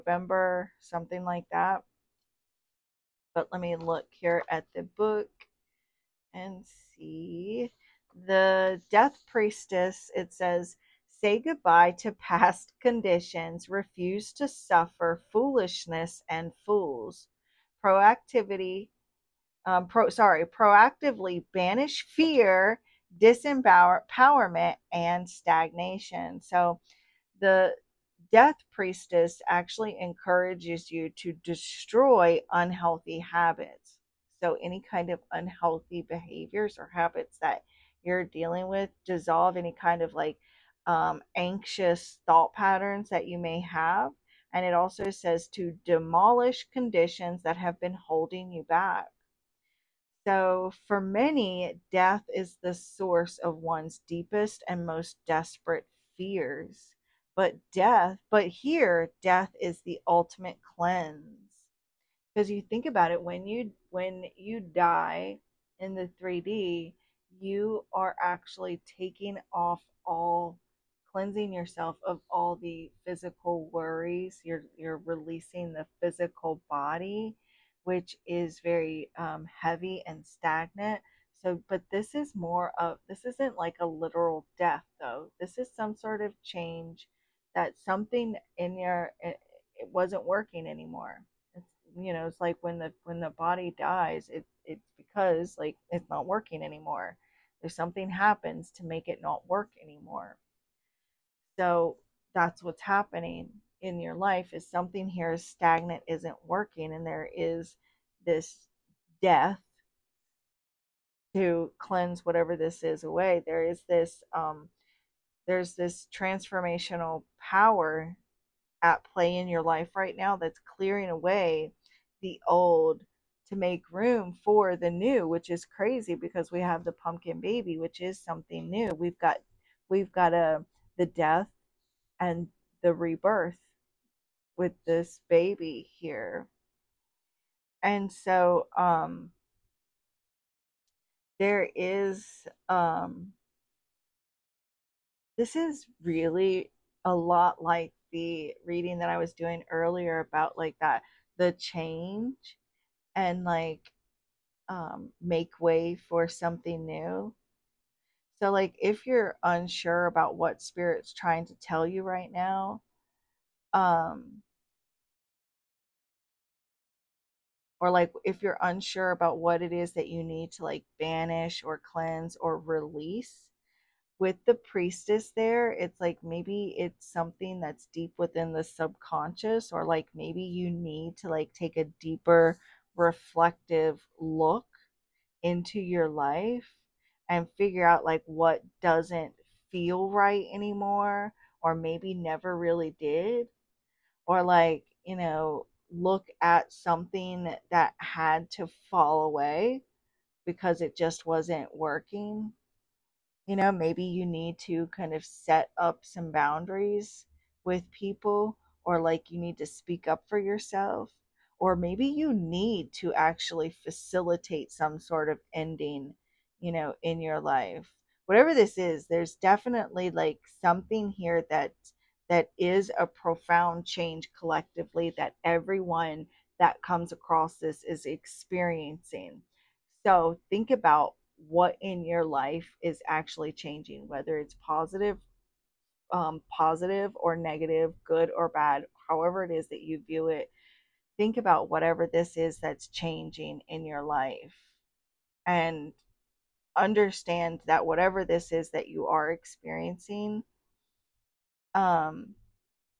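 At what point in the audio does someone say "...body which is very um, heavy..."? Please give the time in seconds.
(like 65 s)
76 s.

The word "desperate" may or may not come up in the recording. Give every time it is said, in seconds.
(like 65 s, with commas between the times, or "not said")
55 s.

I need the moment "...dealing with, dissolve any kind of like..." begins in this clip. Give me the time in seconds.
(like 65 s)
38 s.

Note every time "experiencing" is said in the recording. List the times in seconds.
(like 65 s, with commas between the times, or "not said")
228 s, 249 s.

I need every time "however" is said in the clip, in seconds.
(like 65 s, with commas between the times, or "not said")
239 s.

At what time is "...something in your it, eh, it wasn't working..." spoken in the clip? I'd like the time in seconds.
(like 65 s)
87 s.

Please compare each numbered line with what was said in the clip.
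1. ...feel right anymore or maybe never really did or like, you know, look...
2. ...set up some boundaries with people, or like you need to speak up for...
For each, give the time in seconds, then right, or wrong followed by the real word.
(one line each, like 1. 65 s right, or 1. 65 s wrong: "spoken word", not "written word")
1. 189 s right
2. 205 s right.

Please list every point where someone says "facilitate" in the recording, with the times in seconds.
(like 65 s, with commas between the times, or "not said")
213 s.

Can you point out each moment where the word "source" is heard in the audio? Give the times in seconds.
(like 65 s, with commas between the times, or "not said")
52 s.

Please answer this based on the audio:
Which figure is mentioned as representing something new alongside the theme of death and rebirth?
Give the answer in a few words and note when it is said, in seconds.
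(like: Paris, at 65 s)
The pumpkin baby, at 126 s.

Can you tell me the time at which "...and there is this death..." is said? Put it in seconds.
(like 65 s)
106 s.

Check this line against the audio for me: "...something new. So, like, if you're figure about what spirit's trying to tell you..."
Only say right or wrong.
wrong.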